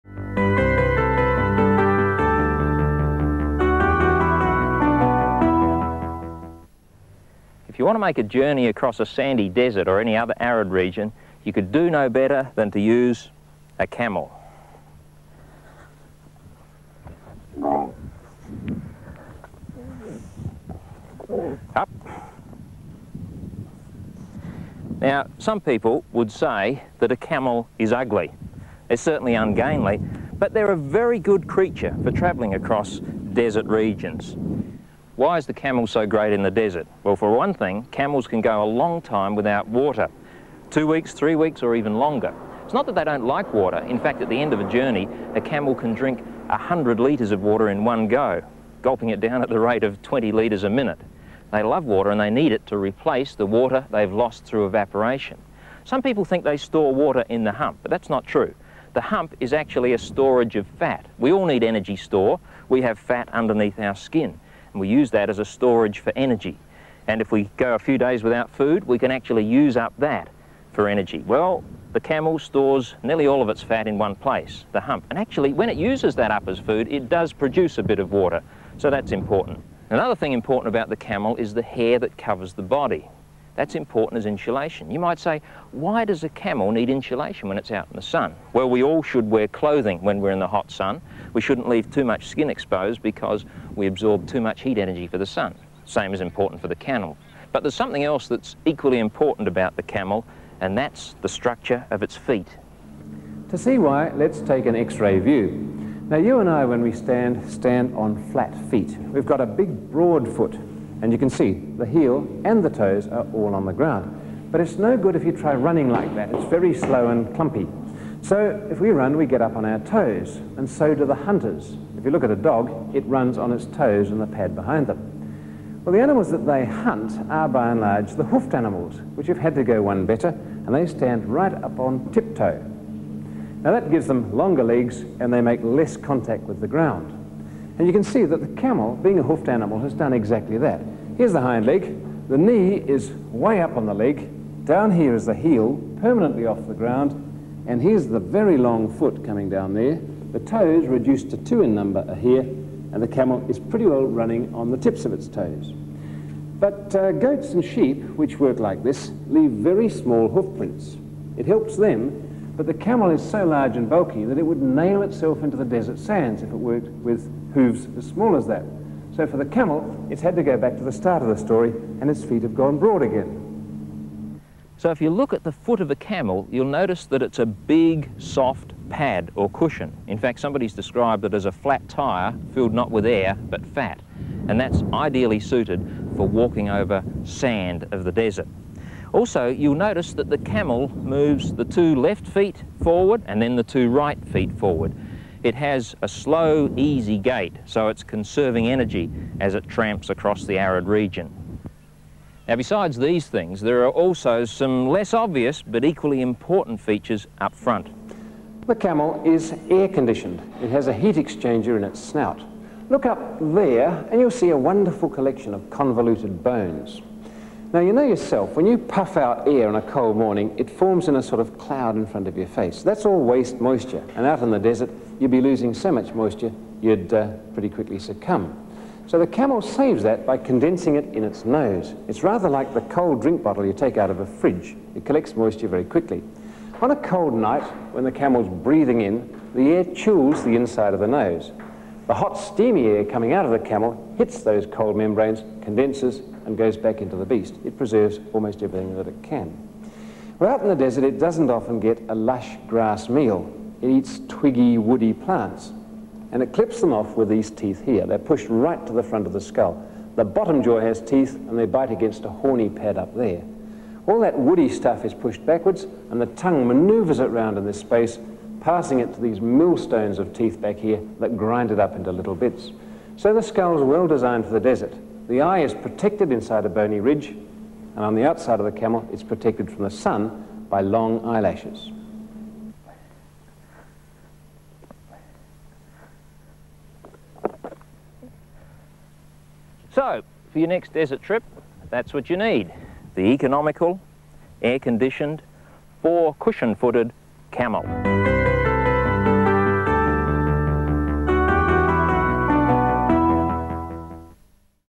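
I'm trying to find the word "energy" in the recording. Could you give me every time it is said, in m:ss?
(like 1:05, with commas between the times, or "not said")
1:01, 1:06, 1:10, 1:34, 3:18.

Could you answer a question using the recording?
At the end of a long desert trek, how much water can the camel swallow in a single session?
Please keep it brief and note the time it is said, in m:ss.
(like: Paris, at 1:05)
100 litres, at 0:46.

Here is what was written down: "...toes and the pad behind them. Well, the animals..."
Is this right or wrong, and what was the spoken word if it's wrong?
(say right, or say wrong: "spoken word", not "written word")
right.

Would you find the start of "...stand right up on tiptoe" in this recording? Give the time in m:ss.
2:10.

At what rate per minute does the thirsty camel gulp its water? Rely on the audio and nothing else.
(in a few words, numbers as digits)
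20 litres a minute.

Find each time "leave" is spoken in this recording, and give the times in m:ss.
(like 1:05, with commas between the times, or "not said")
1:31, 2:39.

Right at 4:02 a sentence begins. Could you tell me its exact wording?
The hot, steamy air coming out of the camel hits those cold membranes, condenses, and goes back into the beast.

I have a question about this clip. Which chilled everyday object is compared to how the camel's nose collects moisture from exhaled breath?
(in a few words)
cold drink bottle.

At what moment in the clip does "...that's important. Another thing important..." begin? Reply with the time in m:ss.
1:18.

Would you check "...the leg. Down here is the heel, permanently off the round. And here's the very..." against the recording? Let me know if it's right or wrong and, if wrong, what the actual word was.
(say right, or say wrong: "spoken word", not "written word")
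wrong: "ground", not "round".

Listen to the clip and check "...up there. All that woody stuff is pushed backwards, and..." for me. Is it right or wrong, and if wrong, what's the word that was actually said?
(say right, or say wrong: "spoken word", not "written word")
right.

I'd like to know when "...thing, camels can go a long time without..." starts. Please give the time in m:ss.
0:37.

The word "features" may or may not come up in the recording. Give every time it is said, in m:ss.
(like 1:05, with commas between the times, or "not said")
3:26.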